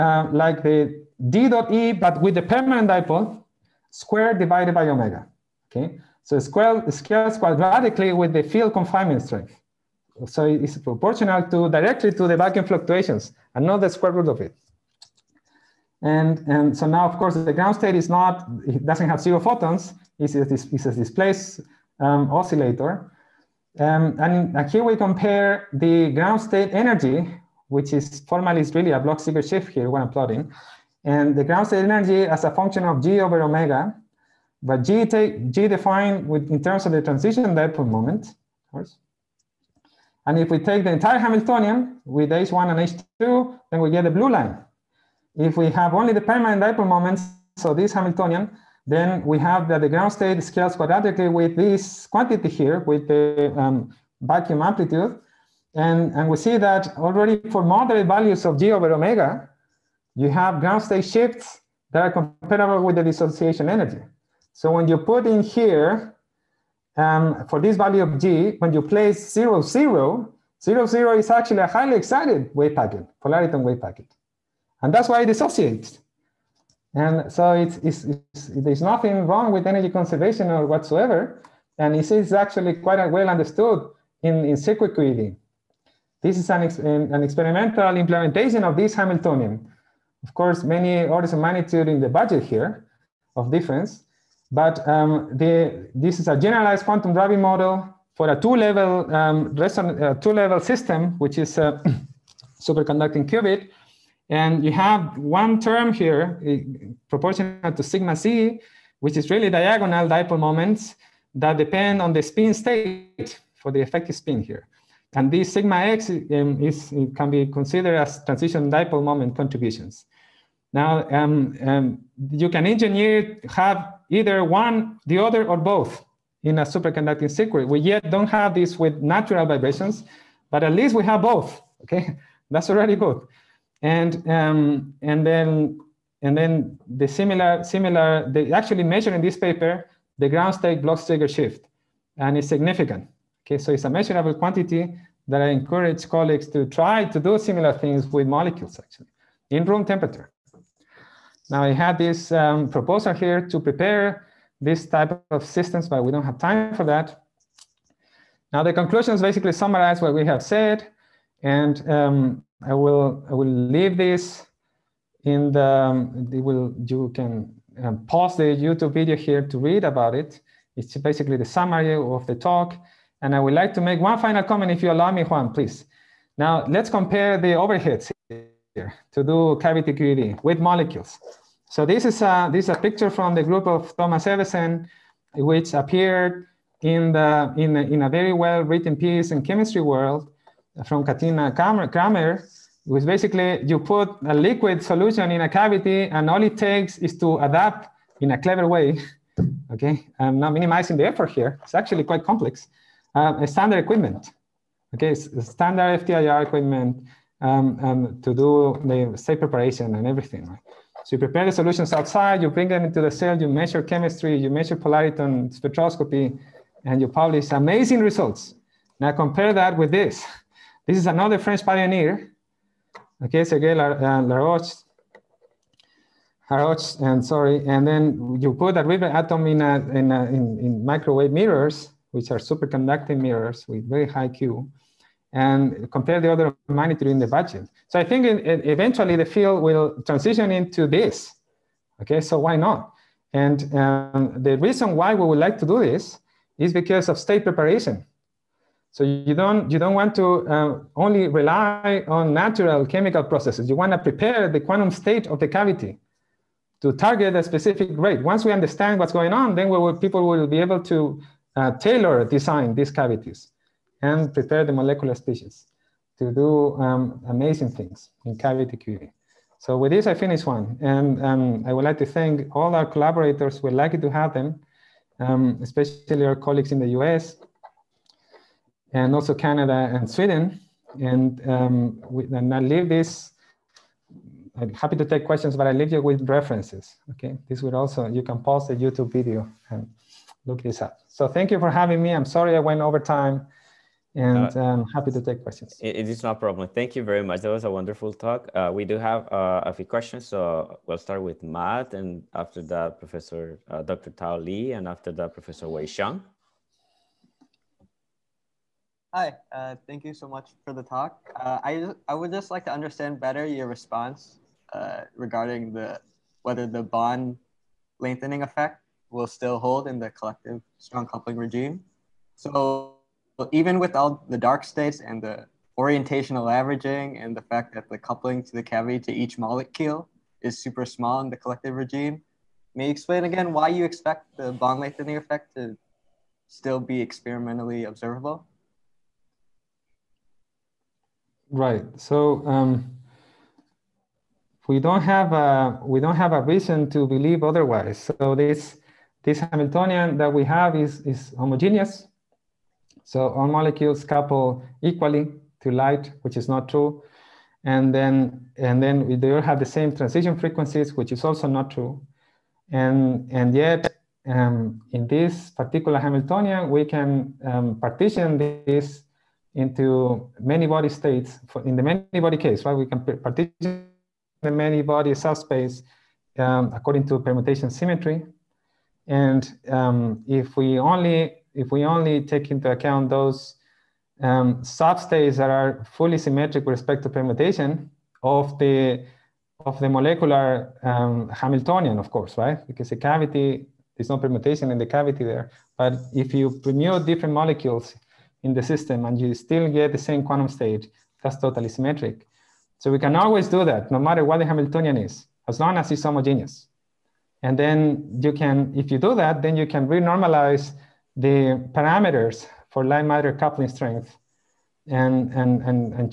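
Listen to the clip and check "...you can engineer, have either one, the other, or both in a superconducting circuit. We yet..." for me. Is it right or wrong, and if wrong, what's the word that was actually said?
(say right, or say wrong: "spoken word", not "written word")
right.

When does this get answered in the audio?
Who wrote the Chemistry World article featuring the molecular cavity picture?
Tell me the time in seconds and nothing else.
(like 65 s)
191 s.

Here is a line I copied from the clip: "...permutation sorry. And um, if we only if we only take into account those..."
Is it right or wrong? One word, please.
wrong.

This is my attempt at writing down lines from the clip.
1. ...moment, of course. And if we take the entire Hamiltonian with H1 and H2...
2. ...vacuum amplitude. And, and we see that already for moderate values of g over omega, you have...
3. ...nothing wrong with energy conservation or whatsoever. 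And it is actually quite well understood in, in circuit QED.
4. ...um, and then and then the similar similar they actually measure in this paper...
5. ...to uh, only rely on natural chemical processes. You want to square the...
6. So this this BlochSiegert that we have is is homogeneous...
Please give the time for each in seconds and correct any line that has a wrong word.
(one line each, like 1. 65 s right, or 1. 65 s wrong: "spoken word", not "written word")
1. 37 s right
2. 54 s right
3. 78 s right
4. 134 s right
5. 250 s wrong: "prepare", not "square"
6. 348 s wrong: "Hamiltonian", not "BlochSiegert".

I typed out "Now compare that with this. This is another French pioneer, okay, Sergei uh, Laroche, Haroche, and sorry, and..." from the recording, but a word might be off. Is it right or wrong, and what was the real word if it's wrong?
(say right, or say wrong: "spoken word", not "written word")
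right.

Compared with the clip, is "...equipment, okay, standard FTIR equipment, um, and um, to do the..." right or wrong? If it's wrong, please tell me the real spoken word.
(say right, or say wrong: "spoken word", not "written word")
right.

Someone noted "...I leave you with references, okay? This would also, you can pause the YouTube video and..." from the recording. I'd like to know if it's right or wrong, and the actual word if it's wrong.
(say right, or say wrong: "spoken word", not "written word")
right.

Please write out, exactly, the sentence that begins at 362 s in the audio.
And, and yet, um, in this particular Hamiltonian, we can um, partition this into many body states.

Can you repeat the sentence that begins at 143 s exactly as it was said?
Okay, so it's a measurable quantity that I encourage colleagues to try to do similar things with molecules actually in room temperature.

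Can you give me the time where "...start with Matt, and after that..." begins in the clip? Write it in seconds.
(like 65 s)
300 s.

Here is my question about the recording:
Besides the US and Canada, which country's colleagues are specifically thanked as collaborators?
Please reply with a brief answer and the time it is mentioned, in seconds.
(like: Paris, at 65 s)
Sweden, at 280 s.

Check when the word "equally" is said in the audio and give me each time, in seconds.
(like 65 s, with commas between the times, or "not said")
354 s.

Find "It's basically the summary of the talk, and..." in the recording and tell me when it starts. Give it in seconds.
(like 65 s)
170 s.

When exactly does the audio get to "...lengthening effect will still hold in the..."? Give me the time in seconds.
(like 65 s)
317 s.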